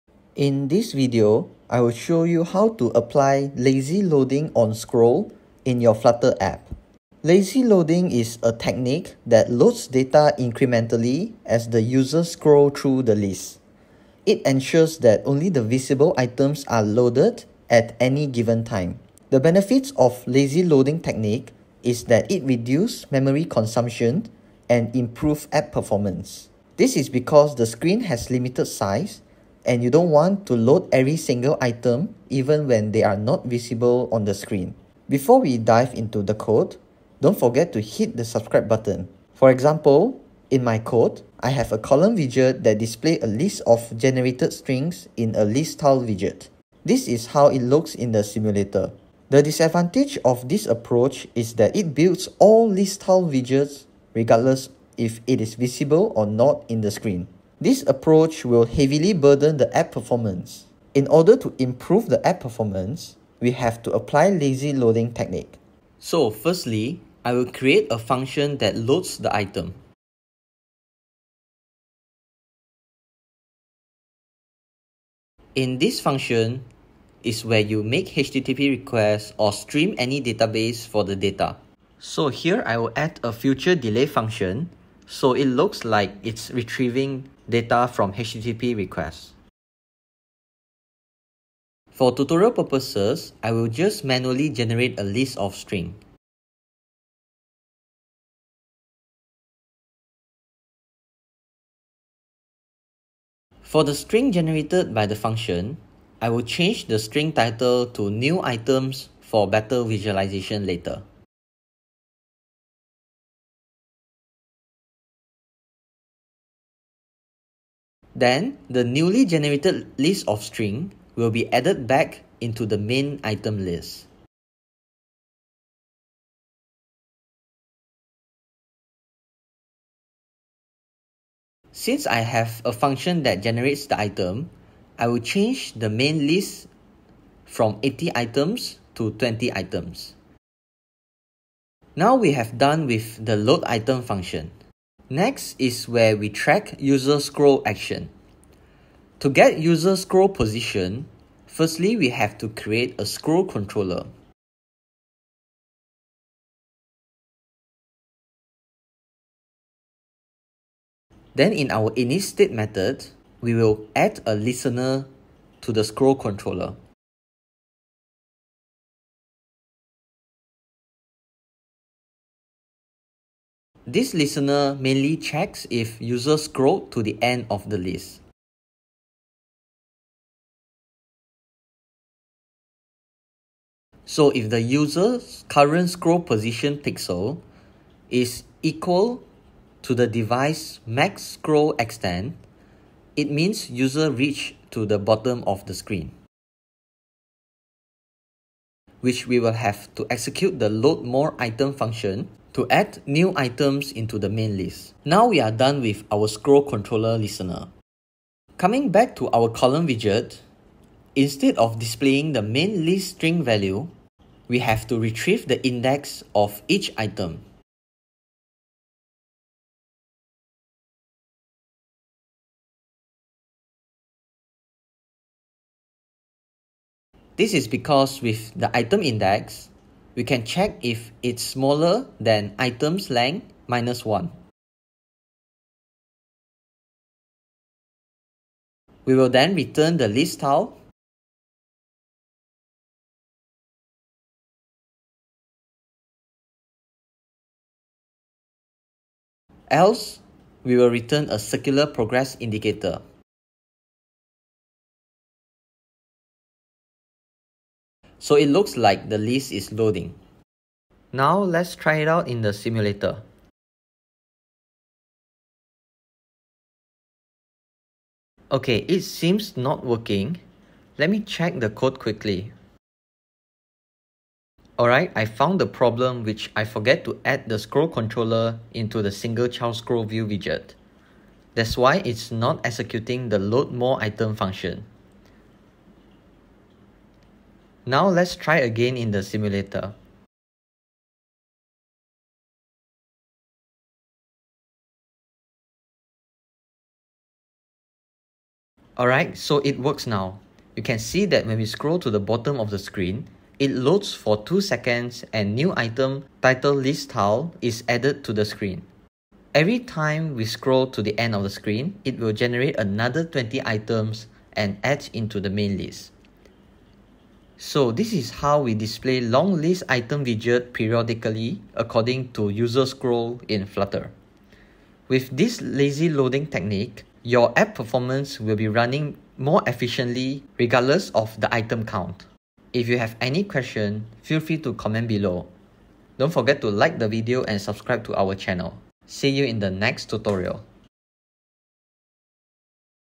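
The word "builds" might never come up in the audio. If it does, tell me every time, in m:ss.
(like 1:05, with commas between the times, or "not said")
0:51.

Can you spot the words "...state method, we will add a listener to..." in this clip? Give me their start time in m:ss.
2:42.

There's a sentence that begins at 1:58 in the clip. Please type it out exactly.
Then, the newly generated list of string will be added back into the main item list.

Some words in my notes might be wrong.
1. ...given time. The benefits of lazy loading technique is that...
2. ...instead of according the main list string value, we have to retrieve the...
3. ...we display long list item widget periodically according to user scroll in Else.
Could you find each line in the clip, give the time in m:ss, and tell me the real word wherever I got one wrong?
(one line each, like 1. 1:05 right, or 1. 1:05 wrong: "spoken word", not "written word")
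1. 0:18 right
2. 3:31 wrong: "displaying", not "according"
3. 5:18 wrong: "Flutter", not "Else".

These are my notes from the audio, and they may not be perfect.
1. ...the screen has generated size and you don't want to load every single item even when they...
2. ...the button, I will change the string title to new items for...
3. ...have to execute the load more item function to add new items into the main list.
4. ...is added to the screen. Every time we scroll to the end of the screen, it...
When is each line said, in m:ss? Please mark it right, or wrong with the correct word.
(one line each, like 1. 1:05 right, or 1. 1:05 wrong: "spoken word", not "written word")
1. 0:27 wrong: "limited", not "generated"
2. 1:45 wrong: "function", not "button"
3. 3:19 right
4. 5:07 right.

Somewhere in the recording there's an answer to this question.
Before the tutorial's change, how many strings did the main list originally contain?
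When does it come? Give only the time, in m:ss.
2:17.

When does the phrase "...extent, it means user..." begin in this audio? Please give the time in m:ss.
3:11.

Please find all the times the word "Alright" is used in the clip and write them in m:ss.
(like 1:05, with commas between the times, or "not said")
4:34, 4:58.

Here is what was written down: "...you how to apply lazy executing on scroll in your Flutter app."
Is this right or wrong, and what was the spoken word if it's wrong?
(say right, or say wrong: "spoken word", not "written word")
wrong: "loading", not "executing".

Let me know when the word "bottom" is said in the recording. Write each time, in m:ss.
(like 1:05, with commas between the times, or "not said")
3:15, 5:02.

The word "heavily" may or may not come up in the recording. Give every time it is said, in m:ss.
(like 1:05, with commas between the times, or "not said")
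0:58.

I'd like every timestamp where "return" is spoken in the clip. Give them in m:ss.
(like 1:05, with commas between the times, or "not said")
3:59, 4:10.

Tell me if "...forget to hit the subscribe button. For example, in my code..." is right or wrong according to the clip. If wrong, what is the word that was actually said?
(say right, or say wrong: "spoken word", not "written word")
right.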